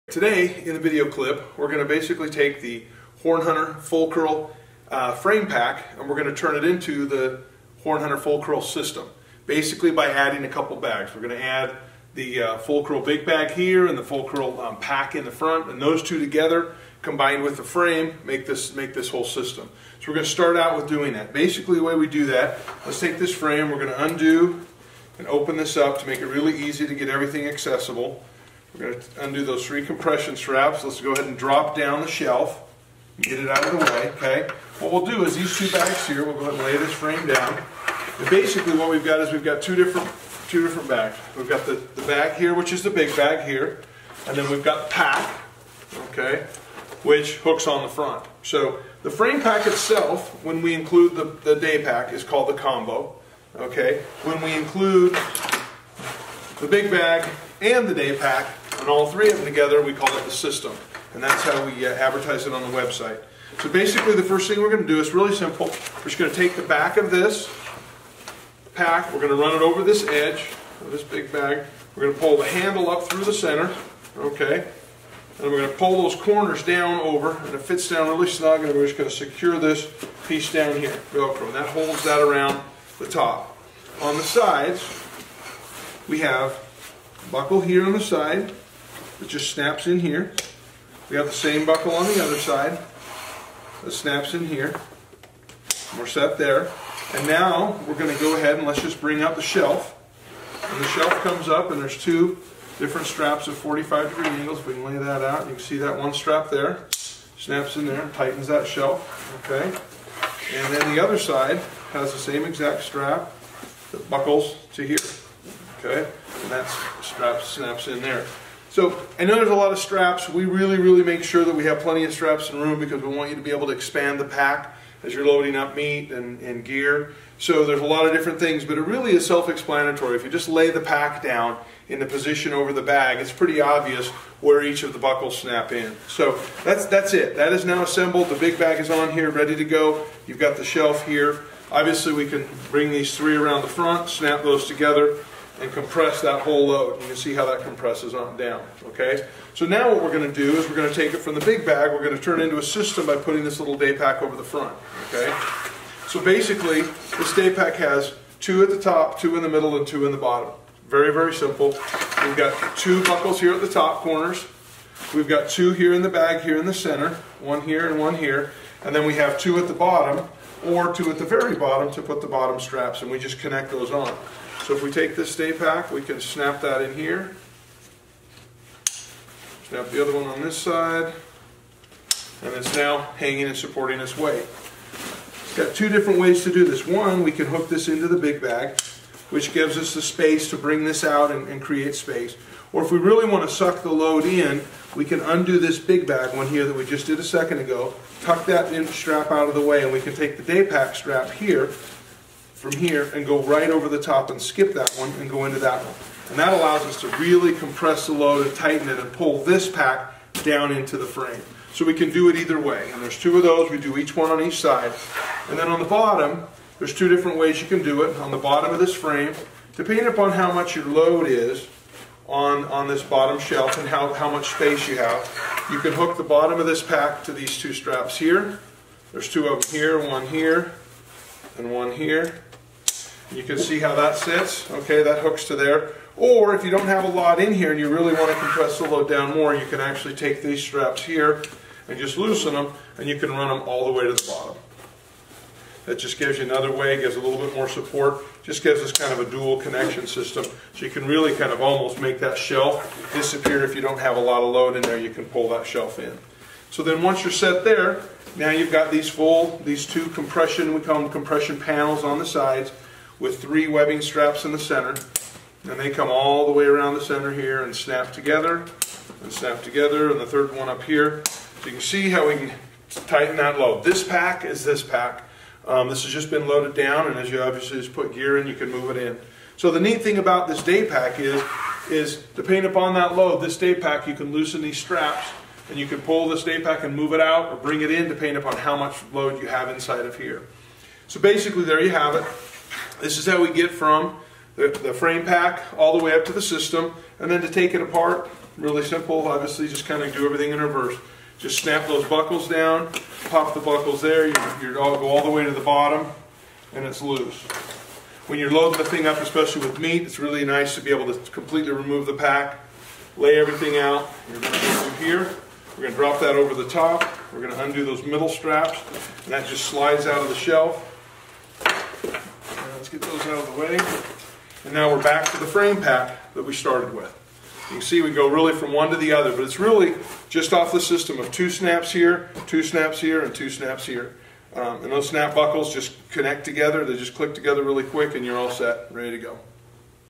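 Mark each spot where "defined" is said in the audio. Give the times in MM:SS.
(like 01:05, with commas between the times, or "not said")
not said.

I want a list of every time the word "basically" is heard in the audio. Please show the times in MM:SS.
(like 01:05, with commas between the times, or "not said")
00:01, 00:09, 00:21, 00:38, 01:03, 02:36, 04:51.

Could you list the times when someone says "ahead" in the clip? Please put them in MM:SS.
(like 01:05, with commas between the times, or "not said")
00:31, 00:36, 01:38.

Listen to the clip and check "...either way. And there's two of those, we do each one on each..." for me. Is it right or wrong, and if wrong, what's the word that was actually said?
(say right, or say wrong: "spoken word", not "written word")
right.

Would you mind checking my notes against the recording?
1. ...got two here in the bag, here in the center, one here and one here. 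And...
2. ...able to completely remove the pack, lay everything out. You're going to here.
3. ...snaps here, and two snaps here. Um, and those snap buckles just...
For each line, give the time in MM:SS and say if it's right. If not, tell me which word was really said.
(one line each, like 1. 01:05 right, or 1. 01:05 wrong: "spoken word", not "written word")
1. 02:45 right
2. 05:10 right
3. 05:32 right.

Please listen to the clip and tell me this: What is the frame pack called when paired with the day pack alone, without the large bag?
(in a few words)
combo.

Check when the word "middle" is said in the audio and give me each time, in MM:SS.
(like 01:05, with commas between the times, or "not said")
02:39, 05:18.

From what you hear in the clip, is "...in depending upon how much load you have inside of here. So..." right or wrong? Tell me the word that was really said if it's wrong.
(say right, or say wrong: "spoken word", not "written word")
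right.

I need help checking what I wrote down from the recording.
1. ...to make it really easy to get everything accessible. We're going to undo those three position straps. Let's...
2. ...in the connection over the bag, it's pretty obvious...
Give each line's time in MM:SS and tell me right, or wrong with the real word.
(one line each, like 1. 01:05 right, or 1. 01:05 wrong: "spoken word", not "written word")
1. 00:26 wrong: "compression", not "position"
2. 02:11 wrong: "position", not "connection".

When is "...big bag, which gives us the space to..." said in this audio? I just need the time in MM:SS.
03:08.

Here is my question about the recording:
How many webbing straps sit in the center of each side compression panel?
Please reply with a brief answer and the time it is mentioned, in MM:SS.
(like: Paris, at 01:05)
3, at 04:23.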